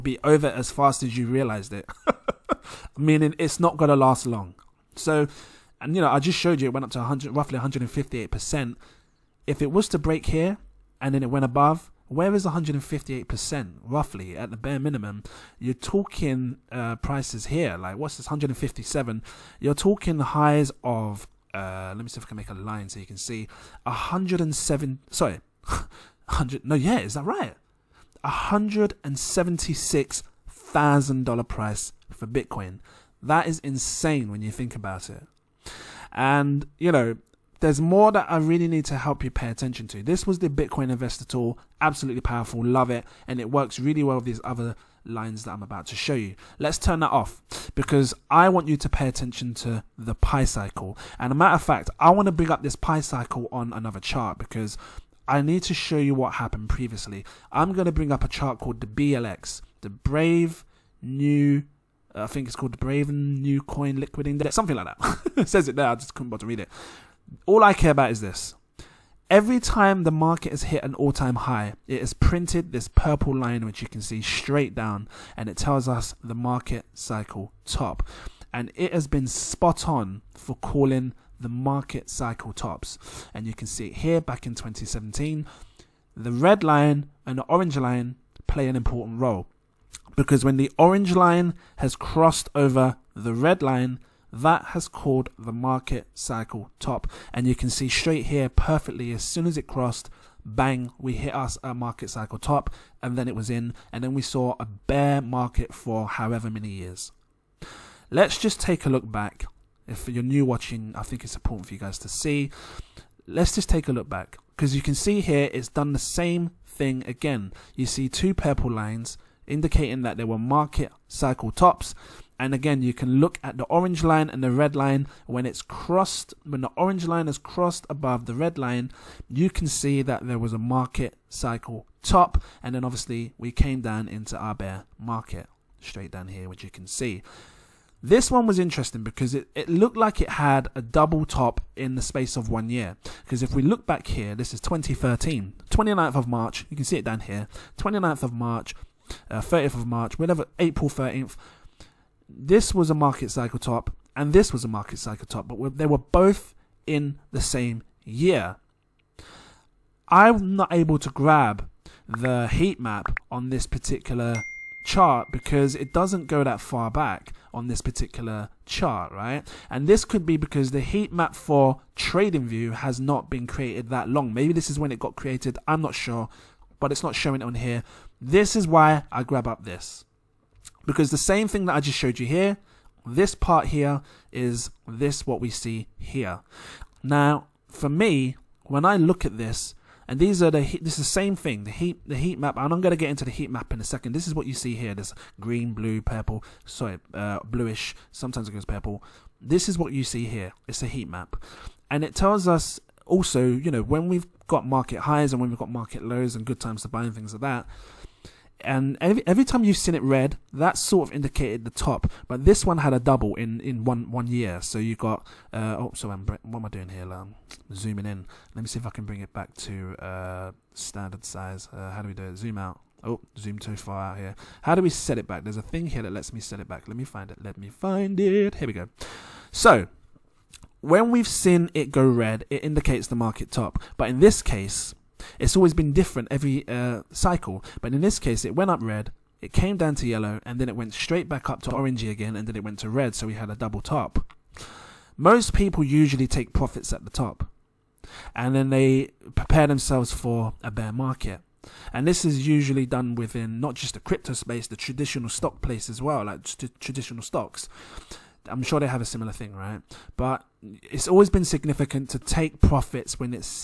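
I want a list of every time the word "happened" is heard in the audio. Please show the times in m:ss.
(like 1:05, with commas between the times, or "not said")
0:56.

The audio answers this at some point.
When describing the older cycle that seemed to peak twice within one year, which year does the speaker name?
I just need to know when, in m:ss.
2:24.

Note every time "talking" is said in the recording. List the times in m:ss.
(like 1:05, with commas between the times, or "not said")
0:15, 0:19.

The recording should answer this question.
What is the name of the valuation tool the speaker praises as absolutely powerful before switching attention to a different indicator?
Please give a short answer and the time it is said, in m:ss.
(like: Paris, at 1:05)
Bitcoin Investor Tool, at 0:40.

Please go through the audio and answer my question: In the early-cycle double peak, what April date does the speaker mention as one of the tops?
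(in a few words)
April 13th.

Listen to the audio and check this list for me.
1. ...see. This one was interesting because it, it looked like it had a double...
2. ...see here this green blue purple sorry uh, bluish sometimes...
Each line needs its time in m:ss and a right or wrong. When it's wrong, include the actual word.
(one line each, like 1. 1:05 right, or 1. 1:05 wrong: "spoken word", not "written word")
1. 2:16 right
2. 3:14 right.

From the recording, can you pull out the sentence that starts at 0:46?
Let's turn that off because I want you to pay attention to the Pi cycle.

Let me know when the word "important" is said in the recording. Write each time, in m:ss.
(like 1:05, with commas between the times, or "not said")
1:28, 1:51.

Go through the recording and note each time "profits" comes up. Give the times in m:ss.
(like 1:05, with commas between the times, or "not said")
4:06, 4:22.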